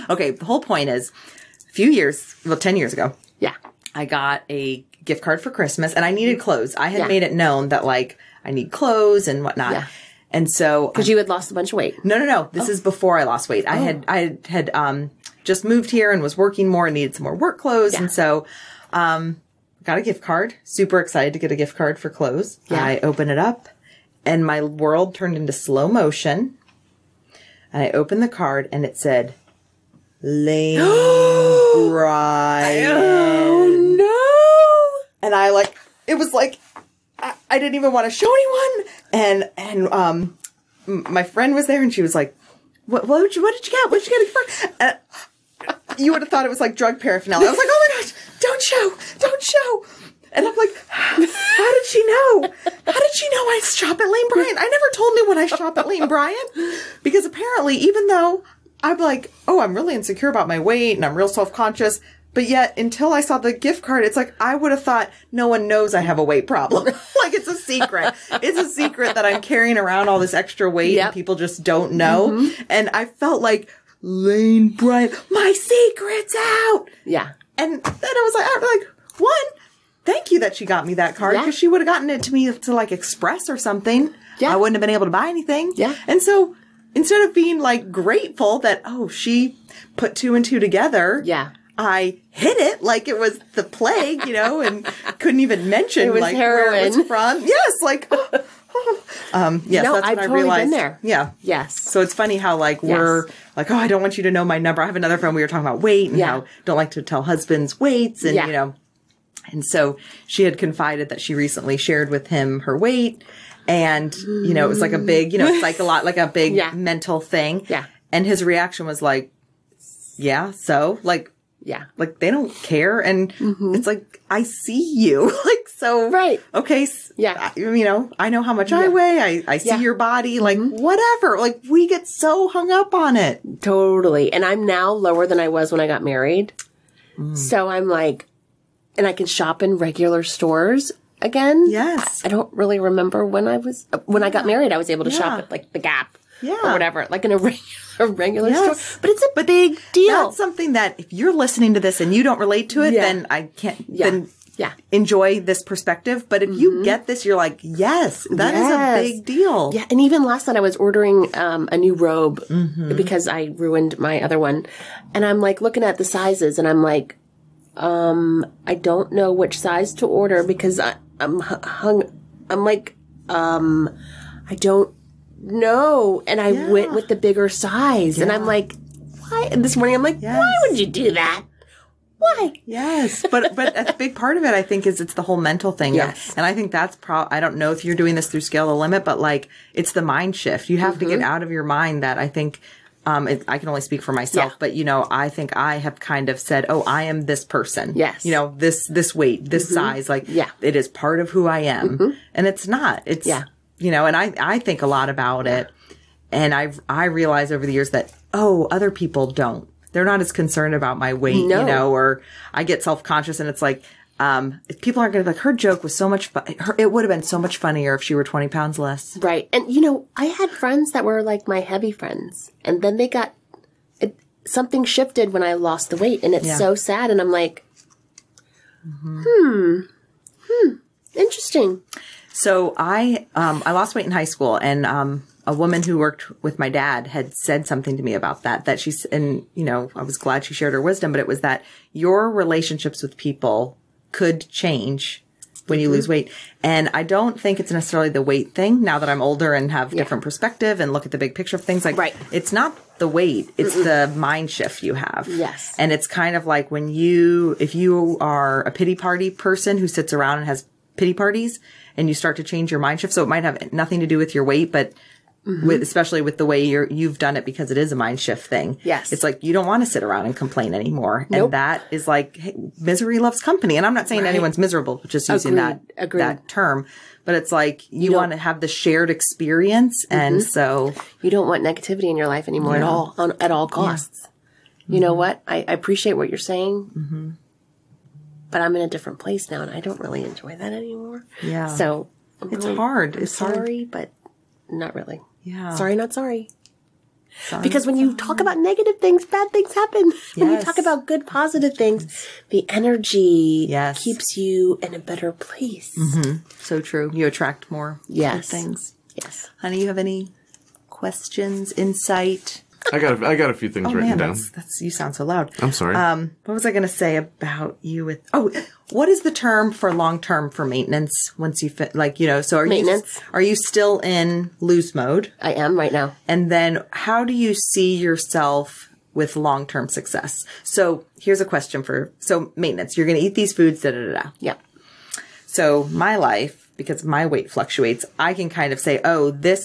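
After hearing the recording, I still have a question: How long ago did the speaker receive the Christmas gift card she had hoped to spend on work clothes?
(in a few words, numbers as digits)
10 years.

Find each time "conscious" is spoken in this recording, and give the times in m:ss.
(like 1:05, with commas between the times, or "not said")
1:01, 3:33.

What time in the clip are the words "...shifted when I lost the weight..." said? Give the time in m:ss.
3:44.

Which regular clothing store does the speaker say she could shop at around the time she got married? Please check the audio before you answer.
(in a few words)
The Gap.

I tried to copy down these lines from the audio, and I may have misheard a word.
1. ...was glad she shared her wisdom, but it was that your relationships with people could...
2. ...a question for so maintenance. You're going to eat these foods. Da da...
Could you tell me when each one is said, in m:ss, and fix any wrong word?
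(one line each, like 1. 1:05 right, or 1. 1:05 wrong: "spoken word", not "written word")
1. 4:00 right
2. 5:31 right.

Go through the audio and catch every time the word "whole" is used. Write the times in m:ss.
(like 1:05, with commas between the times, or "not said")
0:00, 3:05.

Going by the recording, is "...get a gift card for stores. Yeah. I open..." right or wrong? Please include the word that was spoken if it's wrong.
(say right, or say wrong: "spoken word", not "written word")
wrong: "clothes", not "stores".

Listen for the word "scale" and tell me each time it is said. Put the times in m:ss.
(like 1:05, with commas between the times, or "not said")
3:08.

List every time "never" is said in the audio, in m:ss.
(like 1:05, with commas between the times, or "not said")
0:54.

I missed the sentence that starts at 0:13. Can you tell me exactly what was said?
had, I had, um, just moved here and was working more and needed some more work clothes.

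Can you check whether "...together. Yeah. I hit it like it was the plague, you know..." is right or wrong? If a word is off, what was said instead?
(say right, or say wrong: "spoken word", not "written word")
right.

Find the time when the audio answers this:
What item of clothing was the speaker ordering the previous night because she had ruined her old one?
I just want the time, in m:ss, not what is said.
2:41.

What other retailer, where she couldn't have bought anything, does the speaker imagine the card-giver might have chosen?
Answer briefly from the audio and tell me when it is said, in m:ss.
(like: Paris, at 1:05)
Express, at 1:22.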